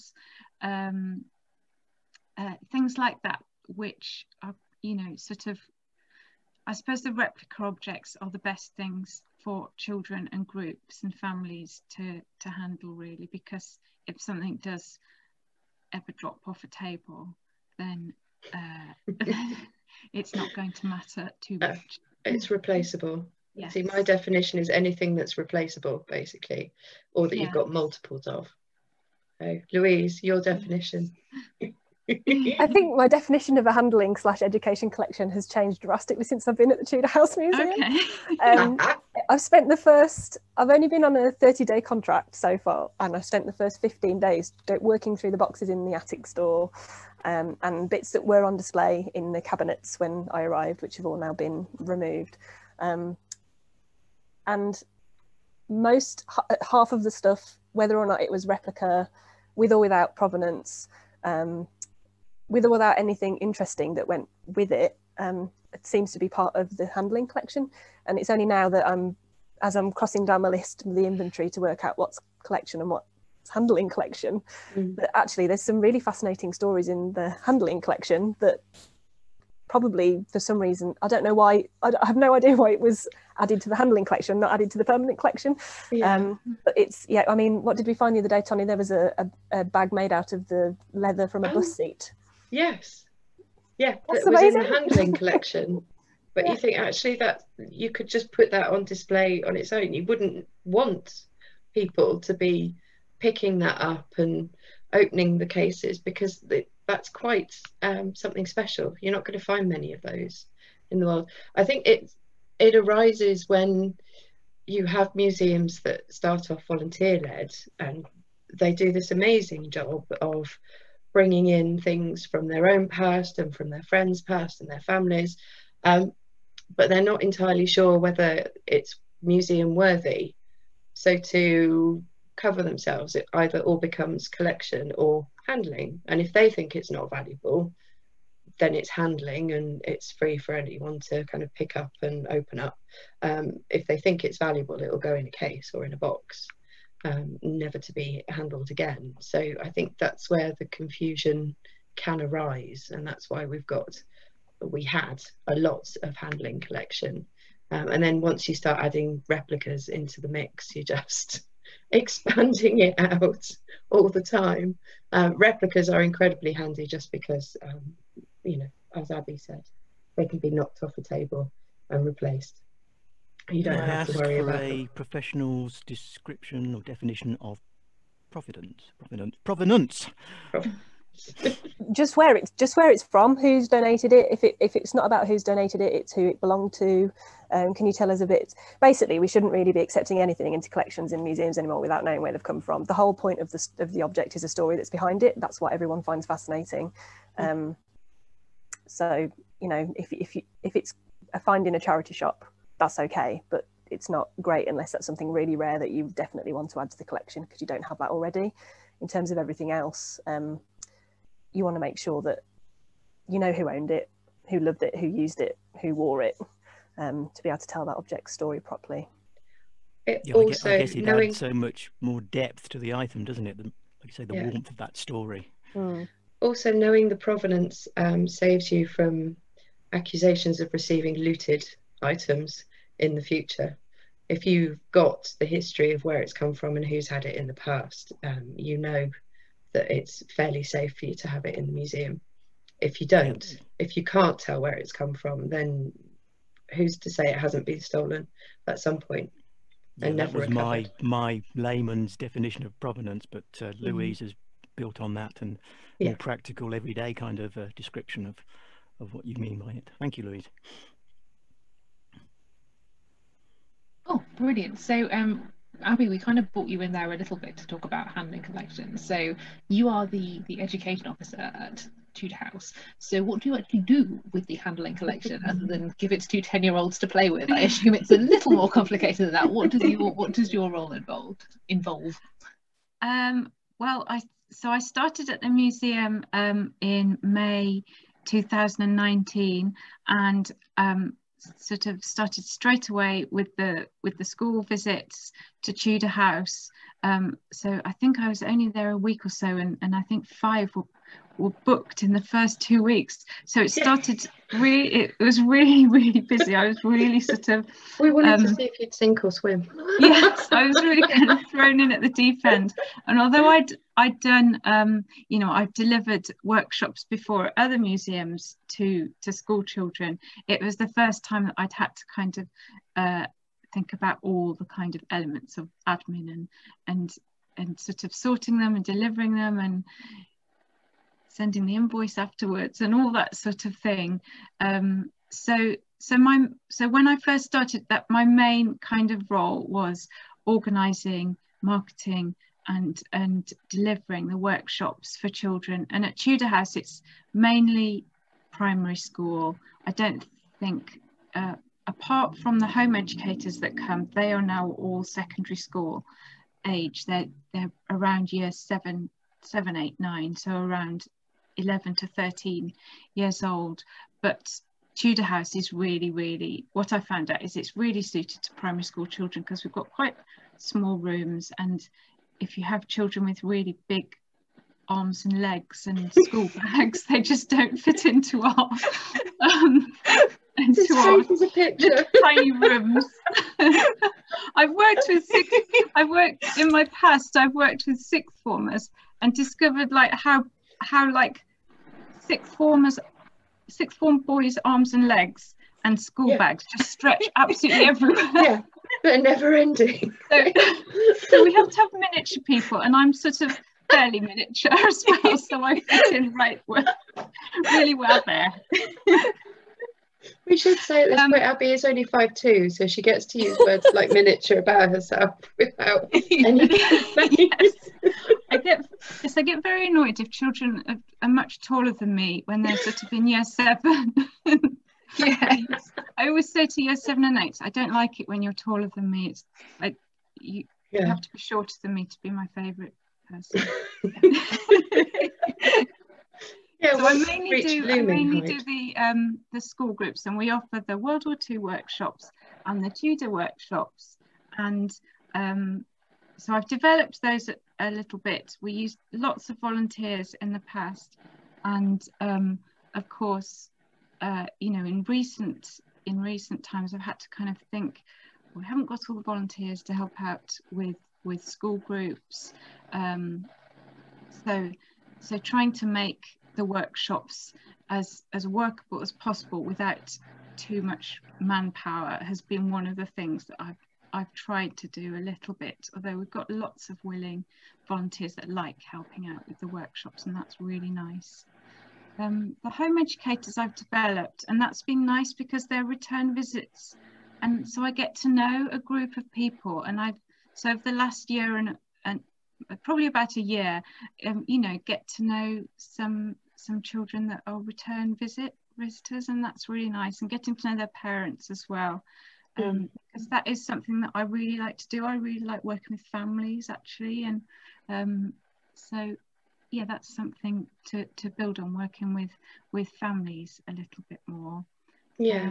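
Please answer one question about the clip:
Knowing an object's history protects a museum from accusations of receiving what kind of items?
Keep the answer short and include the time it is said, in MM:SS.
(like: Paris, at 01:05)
Looted items, at 03:51.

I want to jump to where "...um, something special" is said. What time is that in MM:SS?
01:47.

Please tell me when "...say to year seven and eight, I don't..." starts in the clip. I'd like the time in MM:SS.
07:06.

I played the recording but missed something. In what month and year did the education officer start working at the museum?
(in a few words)
May 2019.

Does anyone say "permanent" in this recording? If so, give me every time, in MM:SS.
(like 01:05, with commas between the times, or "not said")
01:24.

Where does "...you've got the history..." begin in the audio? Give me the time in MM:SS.
03:54.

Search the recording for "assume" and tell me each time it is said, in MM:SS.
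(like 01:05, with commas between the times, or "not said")
04:37.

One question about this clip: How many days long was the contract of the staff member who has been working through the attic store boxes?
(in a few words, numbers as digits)
30.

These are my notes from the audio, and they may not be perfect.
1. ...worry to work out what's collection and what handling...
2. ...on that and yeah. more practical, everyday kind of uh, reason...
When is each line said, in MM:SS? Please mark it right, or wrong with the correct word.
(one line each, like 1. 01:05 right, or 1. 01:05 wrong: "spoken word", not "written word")
1. 01:11 wrong: "inventory", not "worry"
2. 04:14 wrong: "description", not "reason".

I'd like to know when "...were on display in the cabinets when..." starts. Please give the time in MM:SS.
00:48.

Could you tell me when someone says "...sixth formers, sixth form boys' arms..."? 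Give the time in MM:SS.
06:32.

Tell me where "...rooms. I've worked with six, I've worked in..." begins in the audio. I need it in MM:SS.
06:22.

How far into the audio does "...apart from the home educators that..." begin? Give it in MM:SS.
05:51.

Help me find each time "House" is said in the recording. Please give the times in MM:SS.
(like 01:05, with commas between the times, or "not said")
00:37, 04:32, 04:56, 05:46, 06:05.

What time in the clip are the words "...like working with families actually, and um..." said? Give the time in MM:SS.
08:25.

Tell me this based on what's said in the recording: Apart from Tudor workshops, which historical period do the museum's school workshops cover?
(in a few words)
World War II.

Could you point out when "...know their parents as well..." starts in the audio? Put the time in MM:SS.
08:20.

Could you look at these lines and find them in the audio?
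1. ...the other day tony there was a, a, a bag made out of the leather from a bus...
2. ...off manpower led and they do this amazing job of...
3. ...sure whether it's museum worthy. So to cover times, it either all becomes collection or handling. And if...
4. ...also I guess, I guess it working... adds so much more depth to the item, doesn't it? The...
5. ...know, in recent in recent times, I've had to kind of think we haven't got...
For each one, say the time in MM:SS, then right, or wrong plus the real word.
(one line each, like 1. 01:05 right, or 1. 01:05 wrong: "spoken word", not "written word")
1. 01:28 right
2. 01:56 wrong: "volunteer", not "manpower"
3. 02:07 wrong: "themselves", not "times"
4. 03:40 wrong: "knowing", not "working"
5. 07:34 right.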